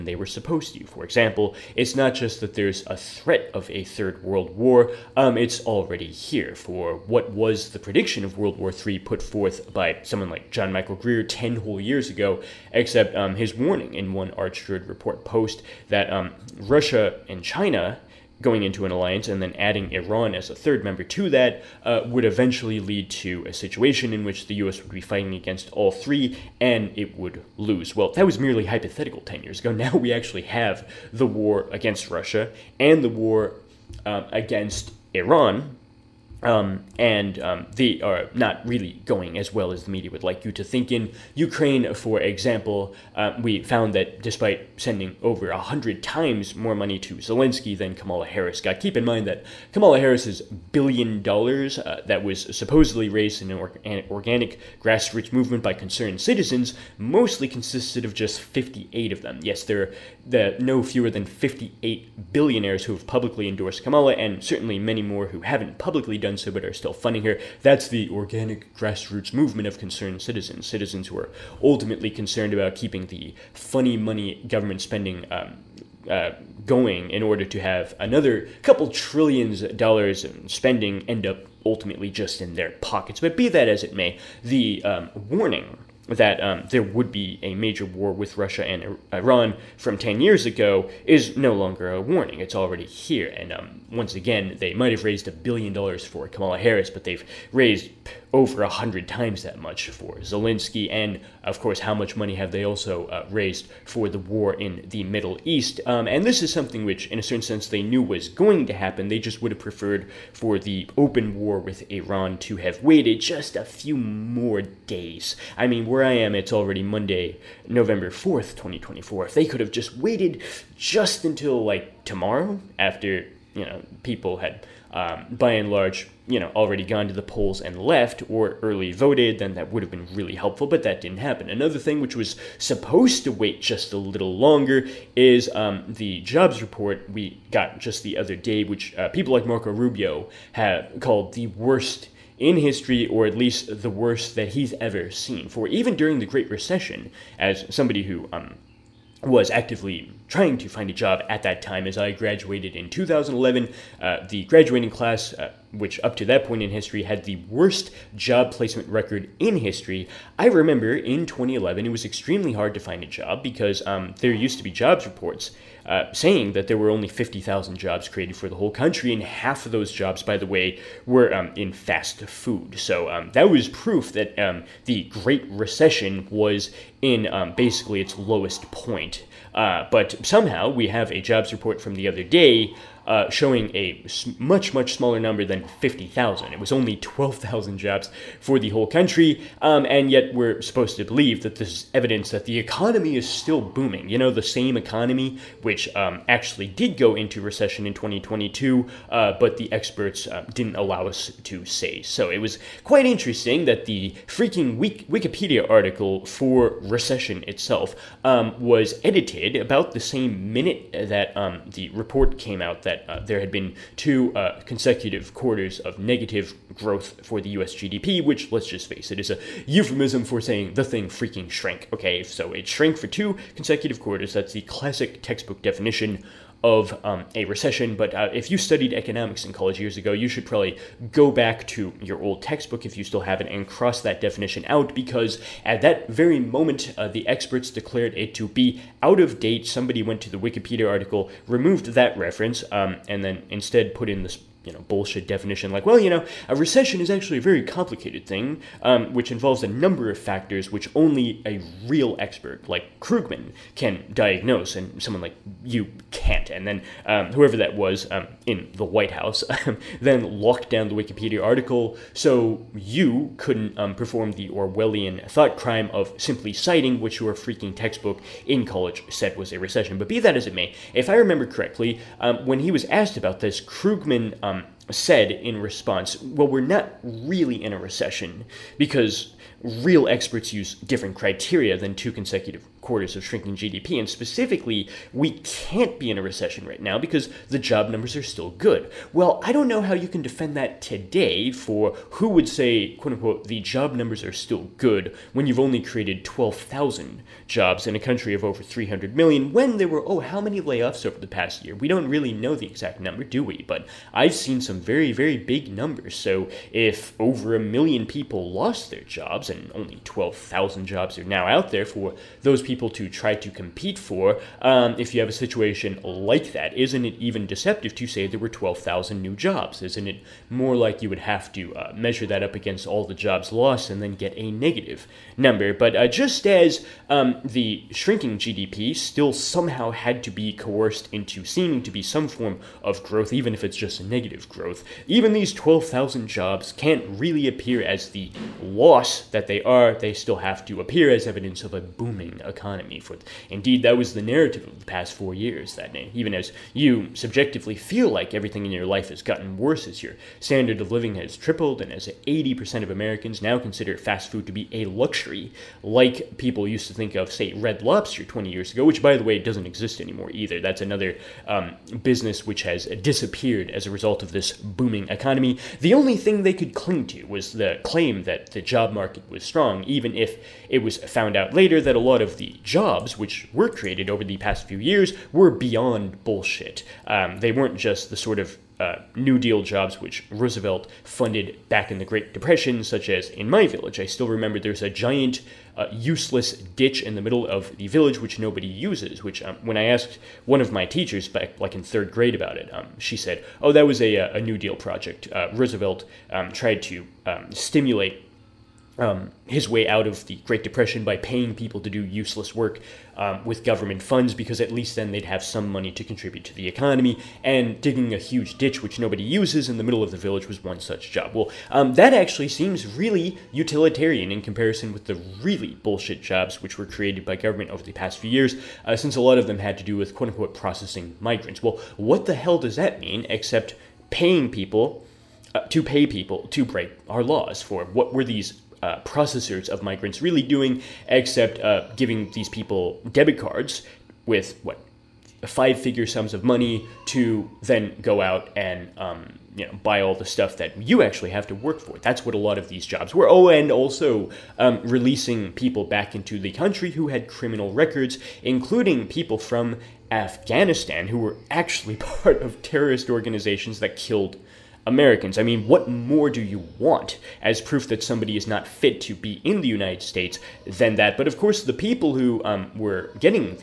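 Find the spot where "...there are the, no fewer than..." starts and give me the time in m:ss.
0:59.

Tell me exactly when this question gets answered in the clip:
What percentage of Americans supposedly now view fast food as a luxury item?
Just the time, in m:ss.
5:52.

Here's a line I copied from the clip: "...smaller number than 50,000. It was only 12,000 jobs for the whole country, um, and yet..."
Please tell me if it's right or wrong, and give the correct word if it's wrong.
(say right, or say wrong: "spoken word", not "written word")
right.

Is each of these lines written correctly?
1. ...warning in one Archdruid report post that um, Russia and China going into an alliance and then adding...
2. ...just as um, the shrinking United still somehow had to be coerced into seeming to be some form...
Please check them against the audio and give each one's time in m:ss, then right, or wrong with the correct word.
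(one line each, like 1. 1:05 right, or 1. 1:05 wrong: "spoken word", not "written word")
1. 0:13 right
2. 5:26 wrong: "GDP", not "United".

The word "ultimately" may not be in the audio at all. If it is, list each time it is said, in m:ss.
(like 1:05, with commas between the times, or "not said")
1:11, 1:21.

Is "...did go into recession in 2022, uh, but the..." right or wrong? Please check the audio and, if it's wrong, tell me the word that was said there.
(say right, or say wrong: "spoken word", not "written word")
right.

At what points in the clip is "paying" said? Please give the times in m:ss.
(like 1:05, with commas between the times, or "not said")
6:41, 7:04.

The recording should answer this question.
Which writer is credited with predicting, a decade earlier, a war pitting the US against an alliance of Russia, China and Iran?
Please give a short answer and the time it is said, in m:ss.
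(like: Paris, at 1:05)
John Michael Greer, at 0:10.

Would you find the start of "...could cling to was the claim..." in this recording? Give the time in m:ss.
6:06.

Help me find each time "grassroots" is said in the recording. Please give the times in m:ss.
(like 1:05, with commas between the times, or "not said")
0:54, 1:08.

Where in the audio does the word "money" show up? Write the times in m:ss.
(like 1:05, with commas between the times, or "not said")
0:46, 1:13, 1:42, 6:45, 7:16.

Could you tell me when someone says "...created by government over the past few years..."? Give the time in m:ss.
6:56.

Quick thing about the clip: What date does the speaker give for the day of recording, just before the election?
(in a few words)
Monday, November 4th, 2024.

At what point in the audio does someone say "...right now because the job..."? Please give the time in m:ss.
4:46.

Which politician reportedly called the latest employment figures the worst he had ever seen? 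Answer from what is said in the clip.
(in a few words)
Marco Rubio.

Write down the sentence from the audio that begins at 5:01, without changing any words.
We don't really know the exact number, do we?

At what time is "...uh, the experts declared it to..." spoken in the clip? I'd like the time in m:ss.
3:56.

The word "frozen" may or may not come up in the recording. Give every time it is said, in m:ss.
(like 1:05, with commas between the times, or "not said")
not said.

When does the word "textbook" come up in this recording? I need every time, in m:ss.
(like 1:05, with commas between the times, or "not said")
3:45, 3:52, 4:27.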